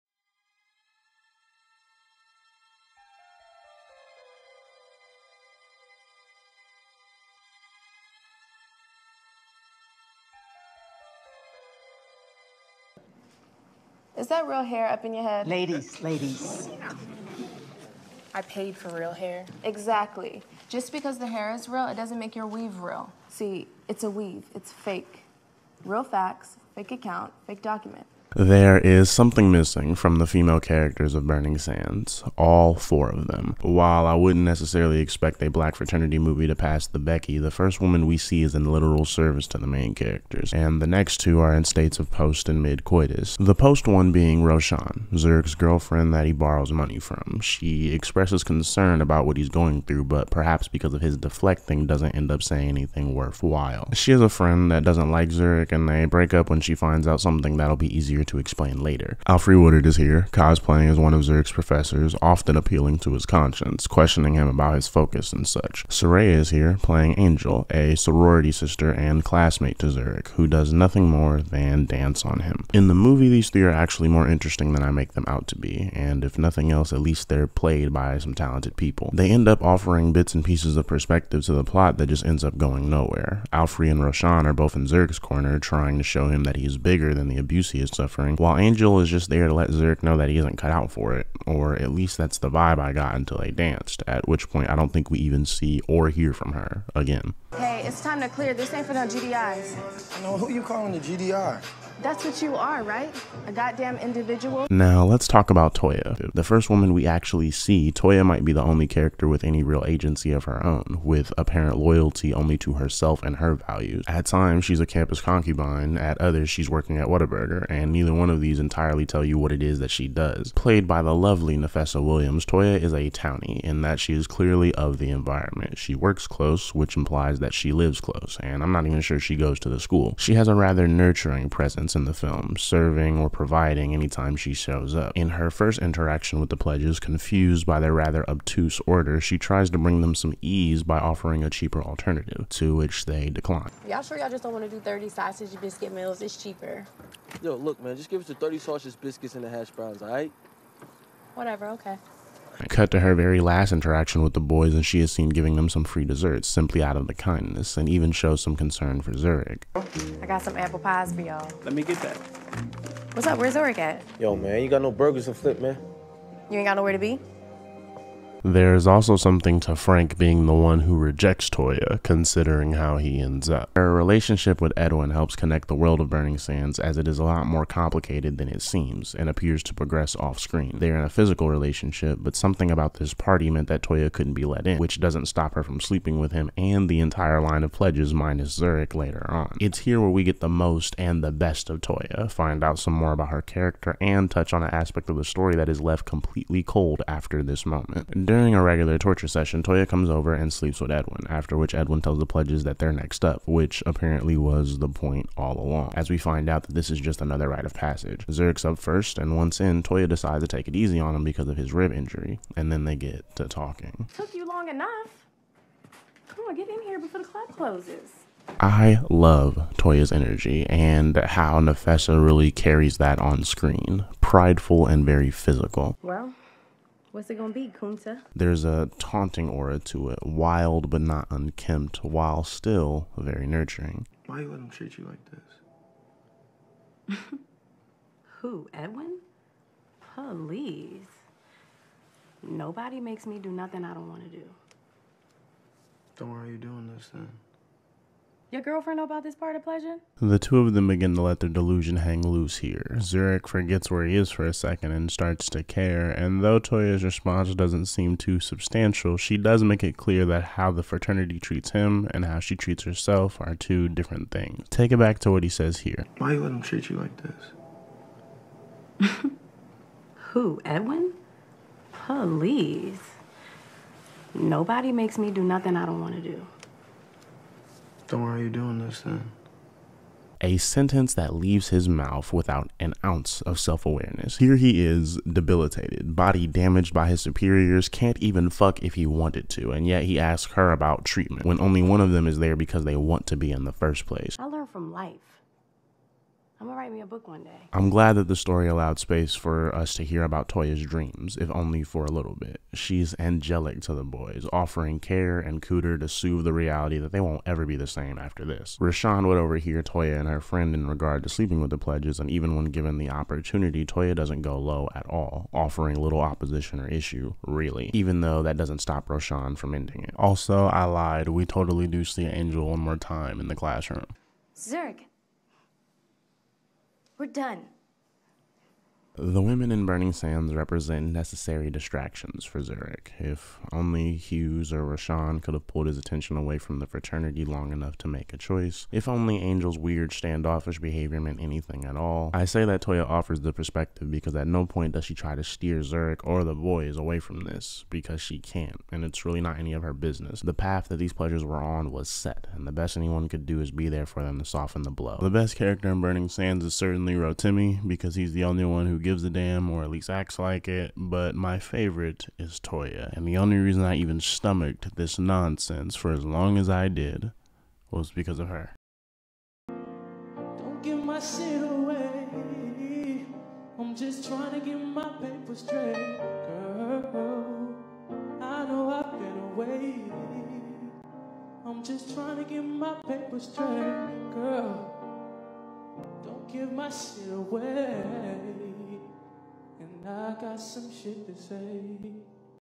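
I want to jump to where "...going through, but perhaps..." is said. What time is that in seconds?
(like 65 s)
49 s.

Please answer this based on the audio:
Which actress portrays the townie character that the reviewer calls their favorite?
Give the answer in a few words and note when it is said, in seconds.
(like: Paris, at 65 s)
Nafessa Williams, at 121 s.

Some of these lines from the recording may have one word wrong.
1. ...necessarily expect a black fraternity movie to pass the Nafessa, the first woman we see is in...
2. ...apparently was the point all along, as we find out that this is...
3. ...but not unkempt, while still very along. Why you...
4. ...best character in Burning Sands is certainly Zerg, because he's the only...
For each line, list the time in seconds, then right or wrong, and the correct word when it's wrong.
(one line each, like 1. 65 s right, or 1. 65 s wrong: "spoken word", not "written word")
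1. 34 s wrong: "Becky", not "Nafessa"
2. 203 s right
3. 230 s wrong: "nurturing", not "along"
4. 355 s wrong: "Rotimi", not "Zerg".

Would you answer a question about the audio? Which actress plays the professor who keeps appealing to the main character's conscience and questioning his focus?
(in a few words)
Alfre Woodard.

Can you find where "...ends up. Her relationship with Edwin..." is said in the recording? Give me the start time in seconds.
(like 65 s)
173 s.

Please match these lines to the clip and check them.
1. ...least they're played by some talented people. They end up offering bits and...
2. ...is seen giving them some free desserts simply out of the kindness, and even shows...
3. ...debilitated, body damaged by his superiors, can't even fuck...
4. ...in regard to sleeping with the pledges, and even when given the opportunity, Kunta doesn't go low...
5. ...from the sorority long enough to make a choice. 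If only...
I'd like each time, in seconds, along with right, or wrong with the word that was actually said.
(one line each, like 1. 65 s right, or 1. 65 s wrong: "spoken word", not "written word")
1. 77 s right
2. 154 s right
3. 285 s right
4. 310 s wrong: "Toya", not "Kunta"
5. 336 s wrong: "fraternity", not "sorority".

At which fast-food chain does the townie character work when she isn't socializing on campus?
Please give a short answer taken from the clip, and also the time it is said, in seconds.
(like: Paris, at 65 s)
Whataburger, at 117 s.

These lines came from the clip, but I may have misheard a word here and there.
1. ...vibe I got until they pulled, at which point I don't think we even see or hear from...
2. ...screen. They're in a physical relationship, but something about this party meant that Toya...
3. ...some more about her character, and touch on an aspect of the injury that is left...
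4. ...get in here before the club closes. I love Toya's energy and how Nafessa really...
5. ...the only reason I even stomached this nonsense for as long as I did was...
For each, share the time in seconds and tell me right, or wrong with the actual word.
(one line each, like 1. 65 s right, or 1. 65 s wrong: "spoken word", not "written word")
1. 92 s wrong: "danced", not "pulled"
2. 180 s right
3. 192 s wrong: "story", not "injury"
4. 216 s right
5. 363 s right.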